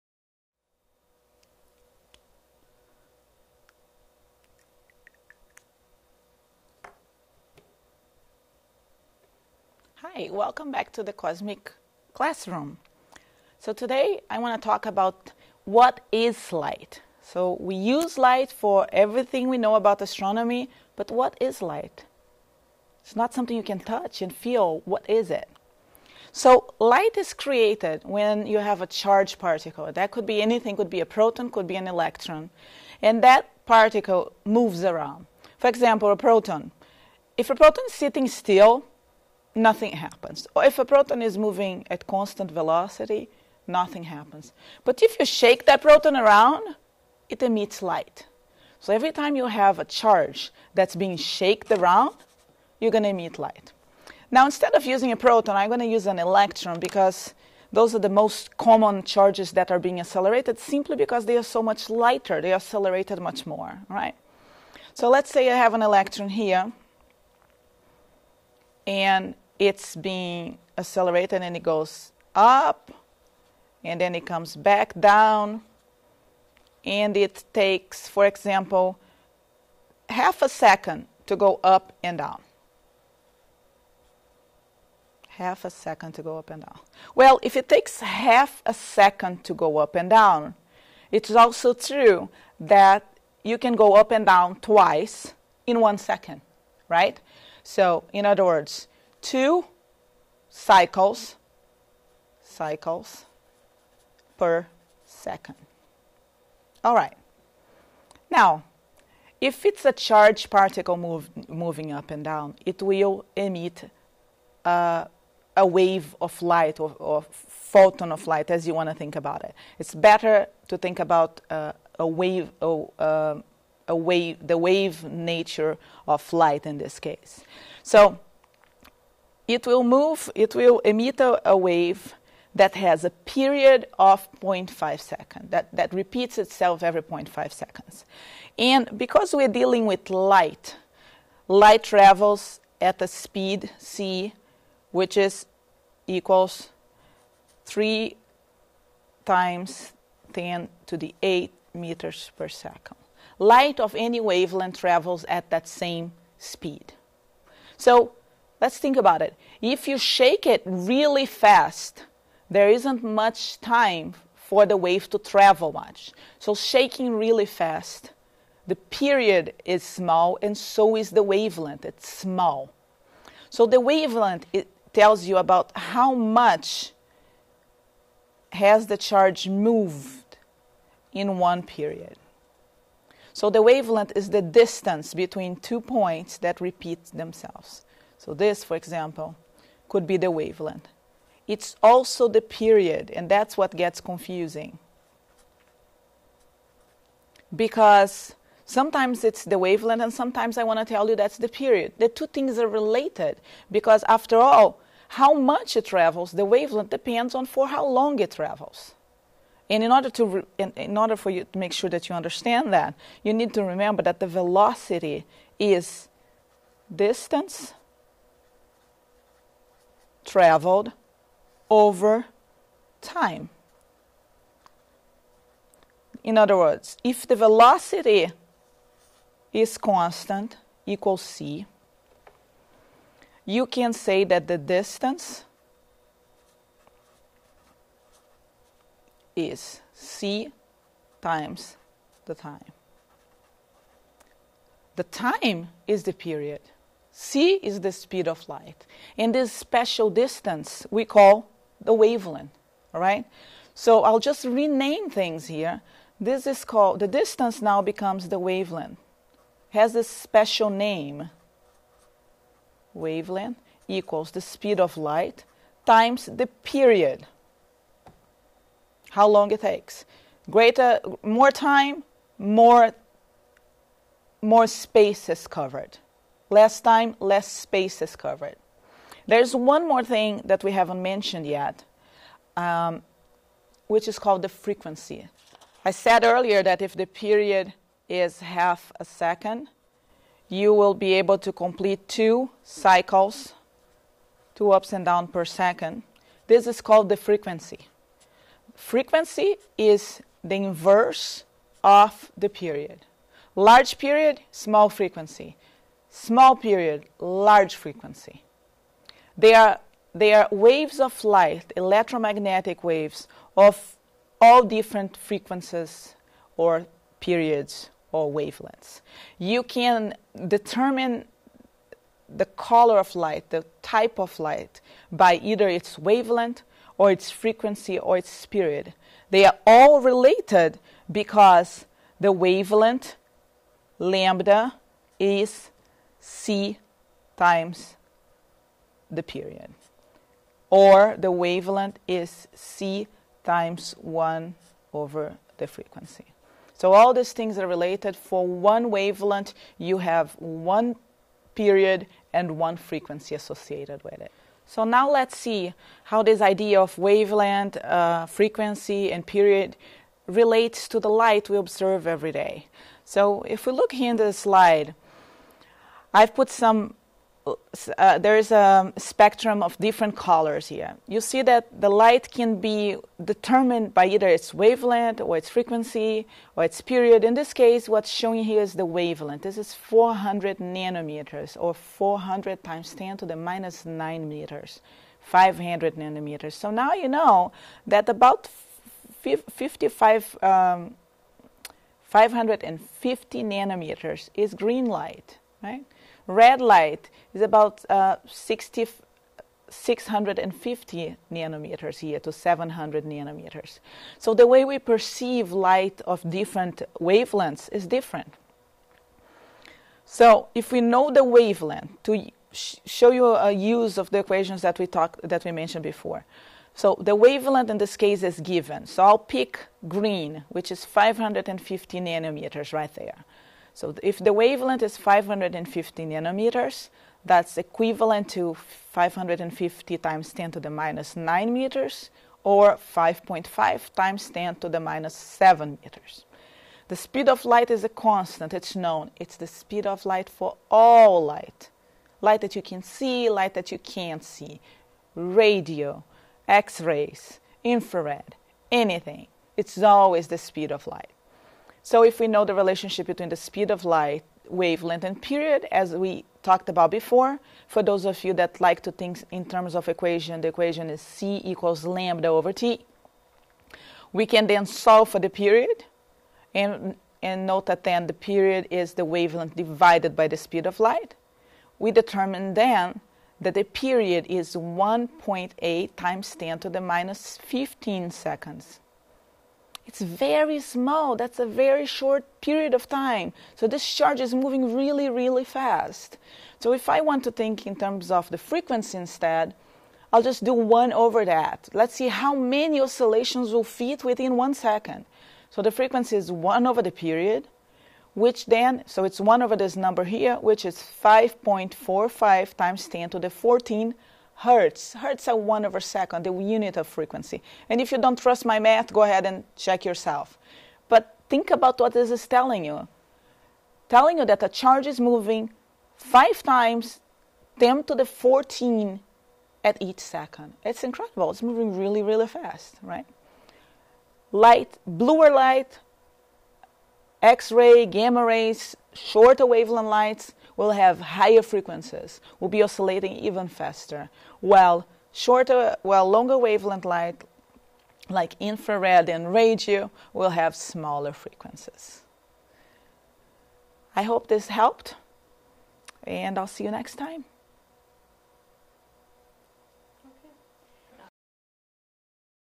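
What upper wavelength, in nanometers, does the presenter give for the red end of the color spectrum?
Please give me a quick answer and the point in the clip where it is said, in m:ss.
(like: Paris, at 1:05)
700 nanometers, at 6:42.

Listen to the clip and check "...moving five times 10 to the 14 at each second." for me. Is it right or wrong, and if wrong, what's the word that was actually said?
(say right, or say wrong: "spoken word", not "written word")
right.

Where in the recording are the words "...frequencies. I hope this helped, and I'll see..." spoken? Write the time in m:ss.
9:01.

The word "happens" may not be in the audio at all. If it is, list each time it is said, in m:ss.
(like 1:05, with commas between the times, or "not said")
0:39, 0:44.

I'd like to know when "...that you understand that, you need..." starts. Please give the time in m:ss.
3:31.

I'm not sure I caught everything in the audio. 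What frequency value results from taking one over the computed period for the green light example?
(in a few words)
5.45 x 10^14 hertz.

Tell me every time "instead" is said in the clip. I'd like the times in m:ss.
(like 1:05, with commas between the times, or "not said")
0:54, 8:08.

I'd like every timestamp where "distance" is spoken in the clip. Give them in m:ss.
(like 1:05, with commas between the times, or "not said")
3:04, 3:36, 3:54, 4:10, 4:17.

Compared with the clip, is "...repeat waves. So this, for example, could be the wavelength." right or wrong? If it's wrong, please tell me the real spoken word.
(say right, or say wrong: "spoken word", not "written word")
wrong: "themselves", not "waves".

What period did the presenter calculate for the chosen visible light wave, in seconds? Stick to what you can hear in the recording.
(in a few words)
1.8 x 10^-15 seconds.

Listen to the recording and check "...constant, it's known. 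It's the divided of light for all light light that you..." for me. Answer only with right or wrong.
wrong.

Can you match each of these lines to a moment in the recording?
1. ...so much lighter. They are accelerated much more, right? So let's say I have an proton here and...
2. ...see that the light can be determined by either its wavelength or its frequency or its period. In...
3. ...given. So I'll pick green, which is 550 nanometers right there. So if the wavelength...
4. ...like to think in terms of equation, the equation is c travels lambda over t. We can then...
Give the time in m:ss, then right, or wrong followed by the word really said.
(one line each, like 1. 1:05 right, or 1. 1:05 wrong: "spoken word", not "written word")
1. 1:01 wrong: "electron", not "proton"
2. 6:11 right
3. 6:58 right
4. 7:38 wrong: "equals", not "travels".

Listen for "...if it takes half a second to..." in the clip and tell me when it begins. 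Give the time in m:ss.
1:27.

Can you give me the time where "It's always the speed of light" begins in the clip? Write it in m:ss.
7:29.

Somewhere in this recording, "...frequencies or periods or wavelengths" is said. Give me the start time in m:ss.
5:15.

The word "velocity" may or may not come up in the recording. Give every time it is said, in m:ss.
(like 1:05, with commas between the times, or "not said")
0:42, 3:34, 3:47.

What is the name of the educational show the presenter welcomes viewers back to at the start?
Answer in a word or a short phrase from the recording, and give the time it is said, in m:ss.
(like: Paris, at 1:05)
Cosmic Classroom, at 0:11.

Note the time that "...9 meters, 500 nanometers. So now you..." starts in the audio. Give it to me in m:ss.
6:23.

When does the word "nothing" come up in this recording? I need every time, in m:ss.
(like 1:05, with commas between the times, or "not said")
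0:39, 0:43.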